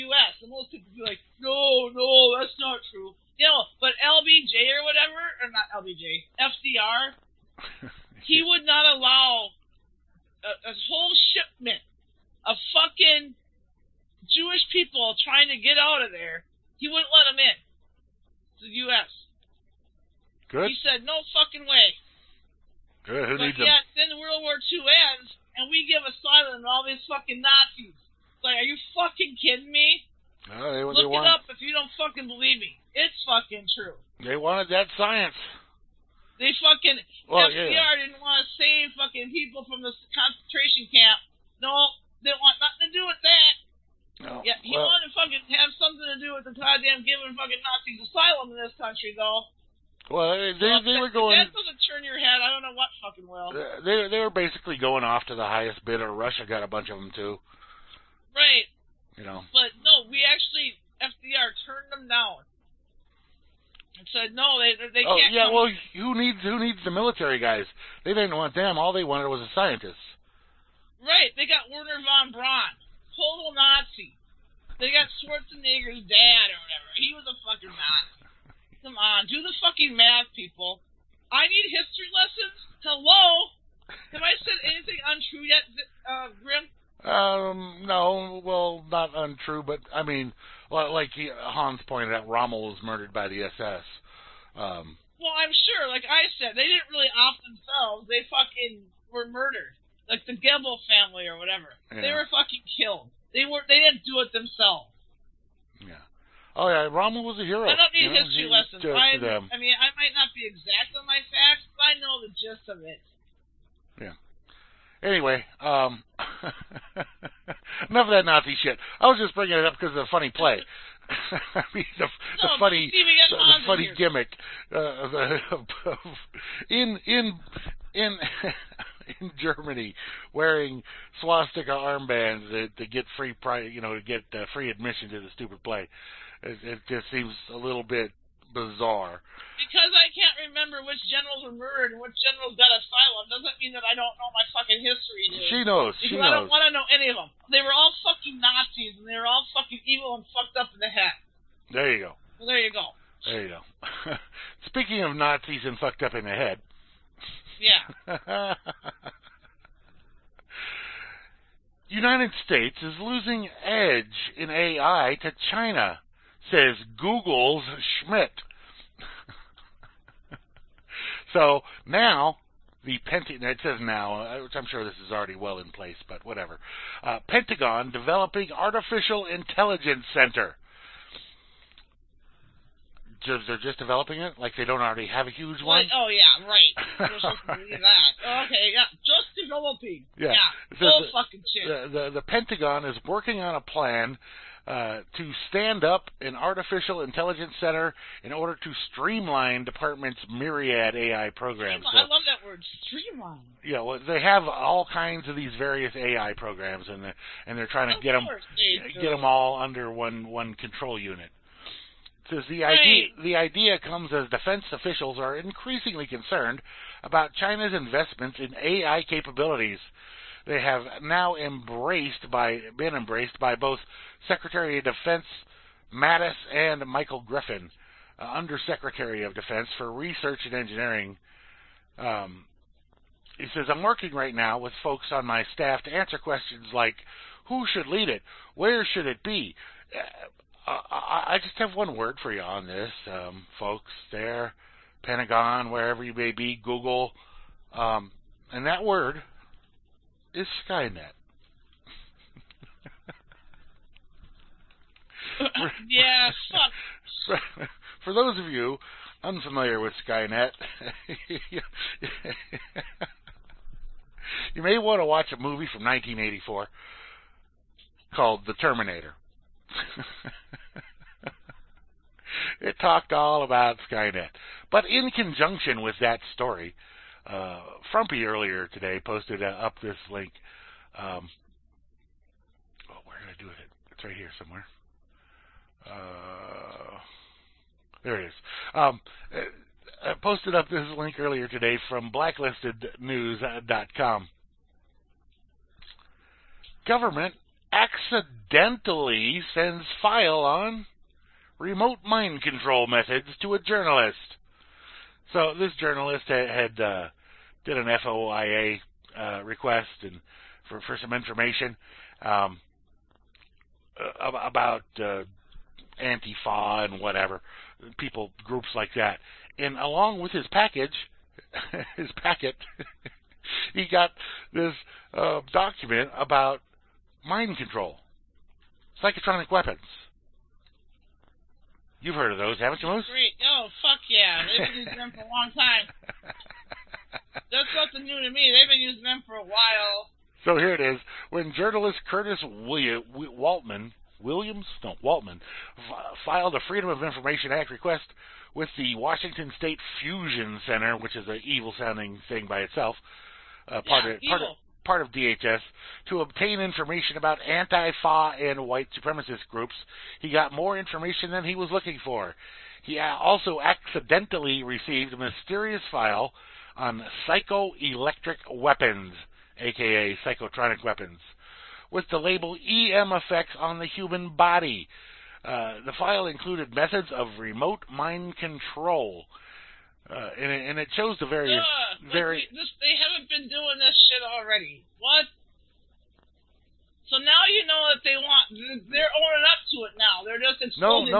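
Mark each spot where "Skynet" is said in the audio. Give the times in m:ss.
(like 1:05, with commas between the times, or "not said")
4:10, 4:20, 4:33.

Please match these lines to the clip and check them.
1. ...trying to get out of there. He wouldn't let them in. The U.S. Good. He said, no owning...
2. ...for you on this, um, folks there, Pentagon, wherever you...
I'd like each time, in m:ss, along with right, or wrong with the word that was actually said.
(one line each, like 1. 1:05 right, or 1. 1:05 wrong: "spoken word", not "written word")
1. 0:15 wrong: "fucking", not "owning"
2. 4:02 right.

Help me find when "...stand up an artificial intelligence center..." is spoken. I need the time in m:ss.
3:15.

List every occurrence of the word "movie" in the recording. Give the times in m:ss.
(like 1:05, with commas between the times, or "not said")
4:25.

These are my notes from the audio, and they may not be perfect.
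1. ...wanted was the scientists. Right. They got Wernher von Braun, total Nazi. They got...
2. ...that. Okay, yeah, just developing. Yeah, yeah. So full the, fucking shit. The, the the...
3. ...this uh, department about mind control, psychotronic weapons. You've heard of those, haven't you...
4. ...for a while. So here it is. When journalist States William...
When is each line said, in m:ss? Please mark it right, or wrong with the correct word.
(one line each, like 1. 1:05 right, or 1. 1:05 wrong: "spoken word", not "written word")
1. 1:09 right
2. 3:07 right
3. 5:24 wrong: "document", not "department"
4. 5:39 wrong: "Curtis", not "States".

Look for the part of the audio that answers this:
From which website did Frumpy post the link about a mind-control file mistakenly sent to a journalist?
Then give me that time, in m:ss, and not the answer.
4:52.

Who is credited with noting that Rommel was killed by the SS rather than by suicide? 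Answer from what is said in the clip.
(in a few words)
Hans.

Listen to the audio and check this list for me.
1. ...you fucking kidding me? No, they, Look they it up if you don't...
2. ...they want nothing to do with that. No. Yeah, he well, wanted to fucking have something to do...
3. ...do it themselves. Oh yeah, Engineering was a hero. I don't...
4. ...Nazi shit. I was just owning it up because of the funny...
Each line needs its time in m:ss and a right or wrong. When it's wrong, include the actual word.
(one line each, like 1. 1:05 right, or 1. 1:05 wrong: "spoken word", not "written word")
1. 0:28 right
2. 0:42 right
3. 1:44 wrong: "Rommel", not "Engineering"
4. 1:58 wrong: "bringing", not "owning".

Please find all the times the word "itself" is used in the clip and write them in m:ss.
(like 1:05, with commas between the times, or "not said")
5:52.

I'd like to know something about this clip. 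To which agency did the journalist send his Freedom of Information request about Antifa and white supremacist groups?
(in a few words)
Washington State Fusion Center.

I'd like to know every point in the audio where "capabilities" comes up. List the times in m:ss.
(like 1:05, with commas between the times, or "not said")
3:39.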